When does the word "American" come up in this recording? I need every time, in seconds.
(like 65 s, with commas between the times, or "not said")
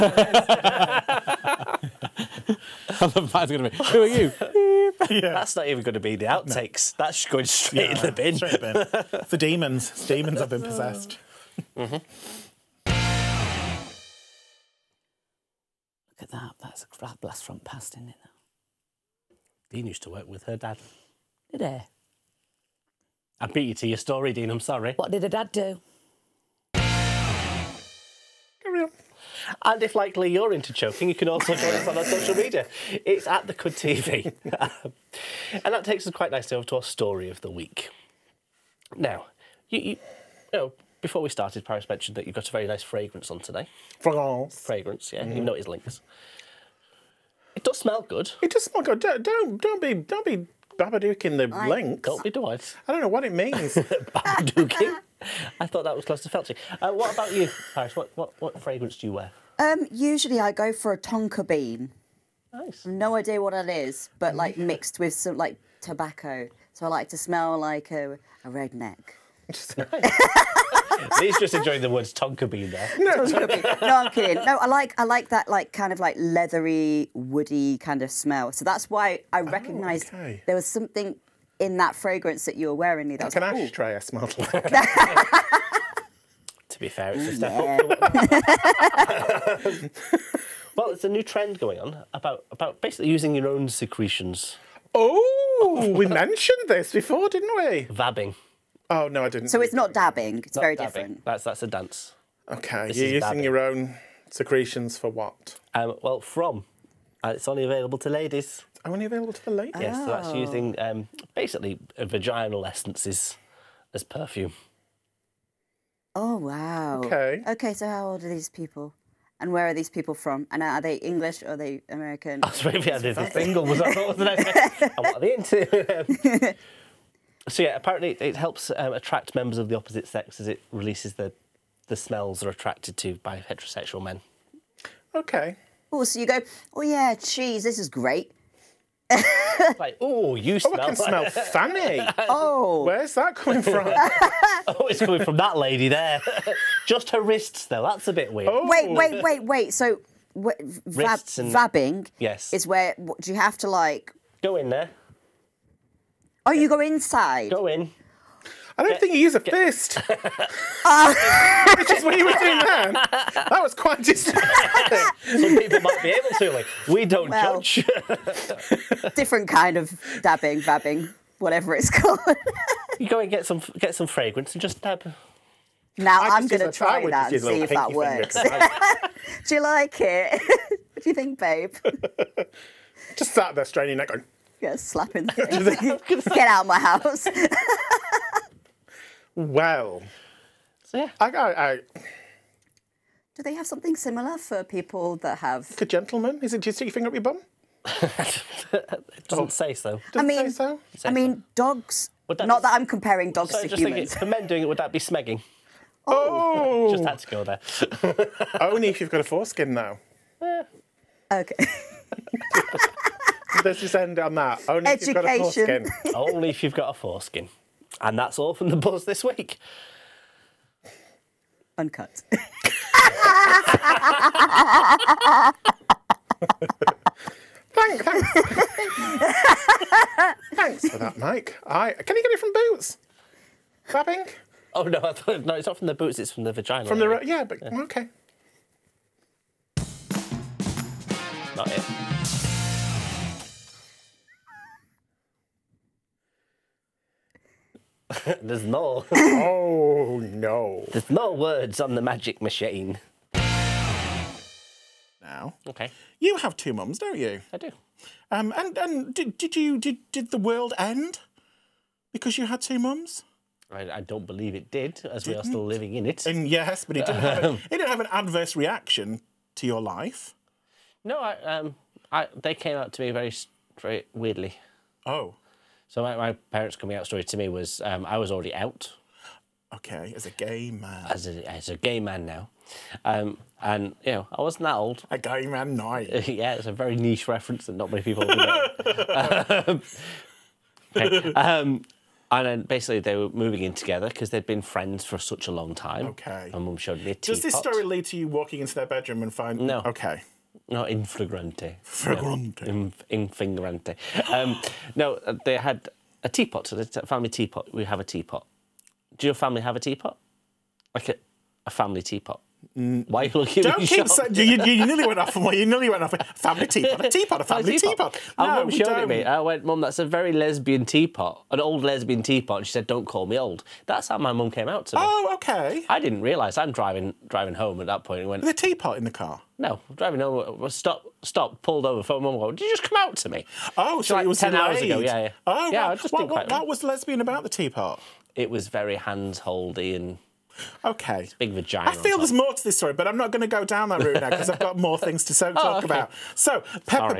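121 s.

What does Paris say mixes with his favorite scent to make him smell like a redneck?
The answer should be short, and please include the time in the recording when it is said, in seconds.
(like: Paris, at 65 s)
tobacco, at 65 s.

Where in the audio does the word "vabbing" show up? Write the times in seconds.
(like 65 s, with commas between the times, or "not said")
97 s, 151 s.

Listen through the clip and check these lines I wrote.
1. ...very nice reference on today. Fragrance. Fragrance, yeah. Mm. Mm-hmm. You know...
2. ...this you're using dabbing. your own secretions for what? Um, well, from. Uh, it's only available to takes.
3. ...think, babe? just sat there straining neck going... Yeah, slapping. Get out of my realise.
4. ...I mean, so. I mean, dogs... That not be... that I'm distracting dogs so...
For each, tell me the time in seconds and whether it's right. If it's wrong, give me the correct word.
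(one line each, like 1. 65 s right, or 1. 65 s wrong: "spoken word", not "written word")
1. 42 s wrong: "fragrance", not "reference"
2. 102 s wrong: "ladies", not "takes"
3. 181 s wrong: "house", not "realise"
4. 200 s wrong: "comparing", not "distracting".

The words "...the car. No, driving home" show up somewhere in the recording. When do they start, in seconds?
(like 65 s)
329 s.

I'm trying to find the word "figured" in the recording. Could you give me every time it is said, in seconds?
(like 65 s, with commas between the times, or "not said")
not said.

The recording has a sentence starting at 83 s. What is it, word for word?
That's like an ashtray I smelled like.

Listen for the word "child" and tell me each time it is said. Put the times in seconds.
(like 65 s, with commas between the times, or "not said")
not said.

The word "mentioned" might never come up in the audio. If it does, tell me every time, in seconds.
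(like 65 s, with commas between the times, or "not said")
41 s, 96 s.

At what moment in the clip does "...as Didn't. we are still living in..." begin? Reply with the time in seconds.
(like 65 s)
265 s.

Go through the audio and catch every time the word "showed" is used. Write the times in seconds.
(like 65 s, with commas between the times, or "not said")
296 s, 318 s.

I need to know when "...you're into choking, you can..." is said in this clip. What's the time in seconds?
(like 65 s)
30 s.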